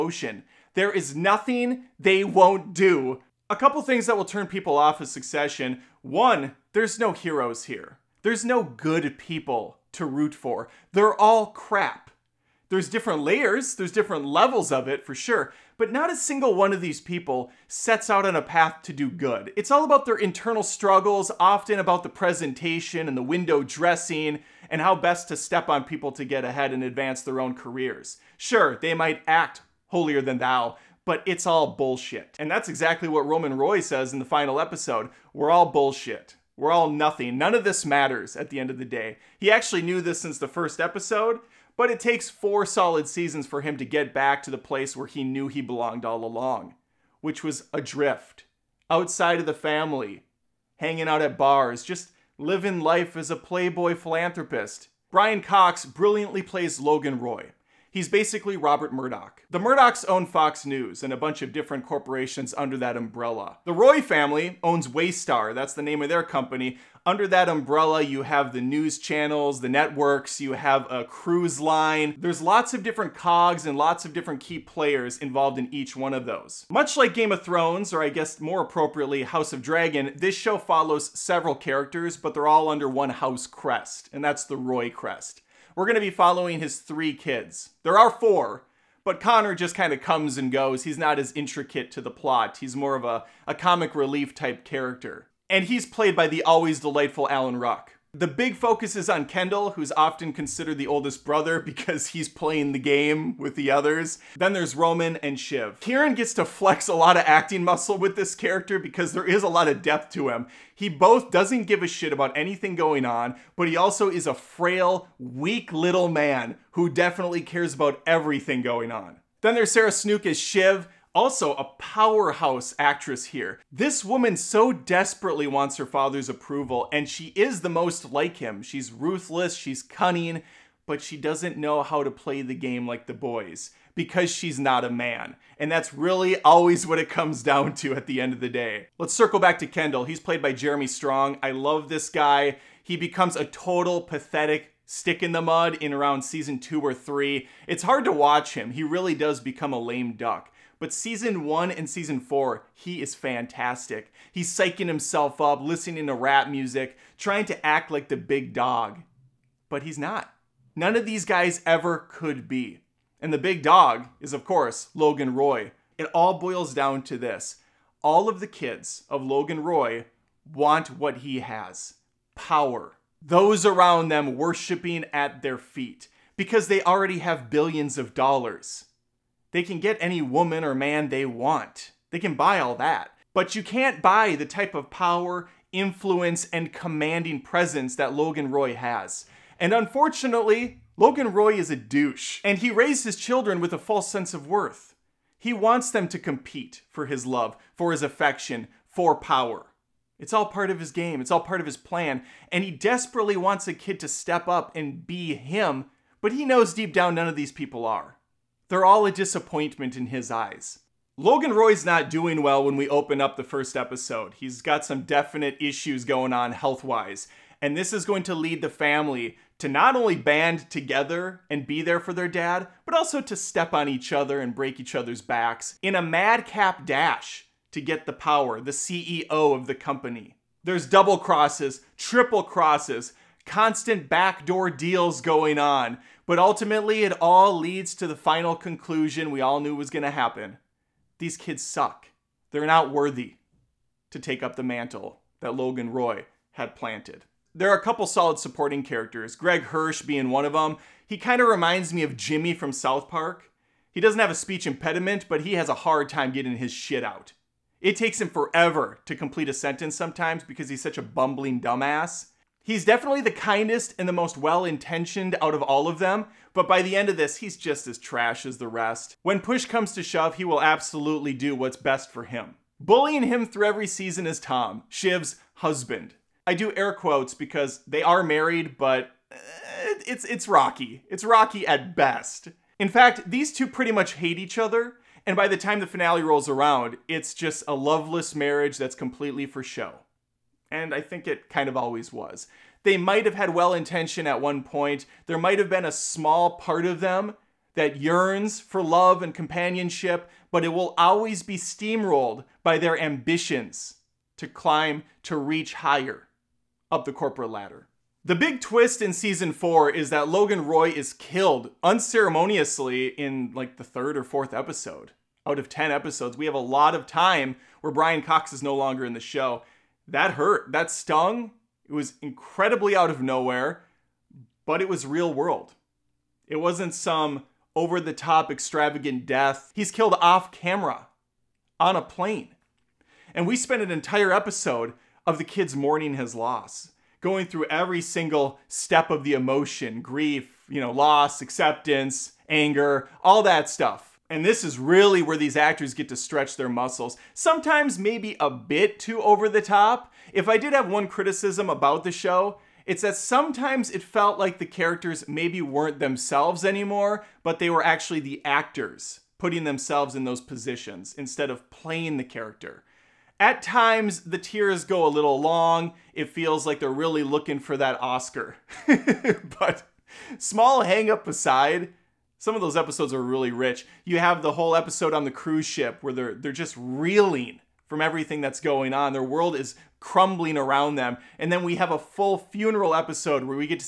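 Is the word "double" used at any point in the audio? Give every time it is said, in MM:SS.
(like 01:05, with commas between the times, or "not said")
03:50.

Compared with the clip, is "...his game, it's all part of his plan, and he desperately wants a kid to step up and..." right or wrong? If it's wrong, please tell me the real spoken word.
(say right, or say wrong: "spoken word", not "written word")
right.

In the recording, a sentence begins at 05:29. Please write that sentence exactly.
He's killed off camera on a plane.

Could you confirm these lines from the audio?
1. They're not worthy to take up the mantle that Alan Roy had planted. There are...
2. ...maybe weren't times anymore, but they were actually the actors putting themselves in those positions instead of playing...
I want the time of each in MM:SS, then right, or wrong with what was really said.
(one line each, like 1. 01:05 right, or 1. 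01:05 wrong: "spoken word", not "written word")
1. 04:02 wrong: "Logan", not "Alan"
2. 05:55 wrong: "themselves", not "times".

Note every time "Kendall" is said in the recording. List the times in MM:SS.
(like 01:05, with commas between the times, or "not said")
01:39, 02:19.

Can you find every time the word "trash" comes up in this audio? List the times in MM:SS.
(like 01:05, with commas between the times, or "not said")
04:27.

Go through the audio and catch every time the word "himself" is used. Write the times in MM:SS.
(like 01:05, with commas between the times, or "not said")
02:34.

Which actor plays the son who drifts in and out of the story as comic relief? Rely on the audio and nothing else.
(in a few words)
Alan Ruck.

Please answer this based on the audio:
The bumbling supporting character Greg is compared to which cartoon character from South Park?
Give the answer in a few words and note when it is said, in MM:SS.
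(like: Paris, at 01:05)
Jimmy, at 04:12.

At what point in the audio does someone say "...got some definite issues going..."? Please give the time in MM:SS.
03:34.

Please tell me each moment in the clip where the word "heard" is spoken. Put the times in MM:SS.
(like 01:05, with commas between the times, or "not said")
not said.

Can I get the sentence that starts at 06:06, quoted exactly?
It feels like they're really looking for that Oscar.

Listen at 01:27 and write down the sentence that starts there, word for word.
There are four, but Connor just kind of comes and goes.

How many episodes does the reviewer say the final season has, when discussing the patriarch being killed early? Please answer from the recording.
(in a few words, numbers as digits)
10.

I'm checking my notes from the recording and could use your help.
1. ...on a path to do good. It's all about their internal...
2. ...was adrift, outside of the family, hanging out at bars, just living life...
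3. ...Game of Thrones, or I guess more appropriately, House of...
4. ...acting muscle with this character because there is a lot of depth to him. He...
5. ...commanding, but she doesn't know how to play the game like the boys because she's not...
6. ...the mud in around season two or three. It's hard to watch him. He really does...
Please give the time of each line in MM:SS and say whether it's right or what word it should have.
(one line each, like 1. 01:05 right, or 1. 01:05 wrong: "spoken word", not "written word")
1. 00:18 right
2. 00:47 right
3. 01:17 right
4. 01:47 right
5. 02:09 wrong: "cunning", not "commanding"
6. 02:25 right.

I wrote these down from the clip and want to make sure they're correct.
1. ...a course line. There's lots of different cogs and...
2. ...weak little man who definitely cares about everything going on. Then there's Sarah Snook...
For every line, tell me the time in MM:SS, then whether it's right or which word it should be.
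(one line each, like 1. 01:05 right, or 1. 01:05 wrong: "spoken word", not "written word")
1. 01:10 wrong: "cruise", not "course"
2. 01:55 right.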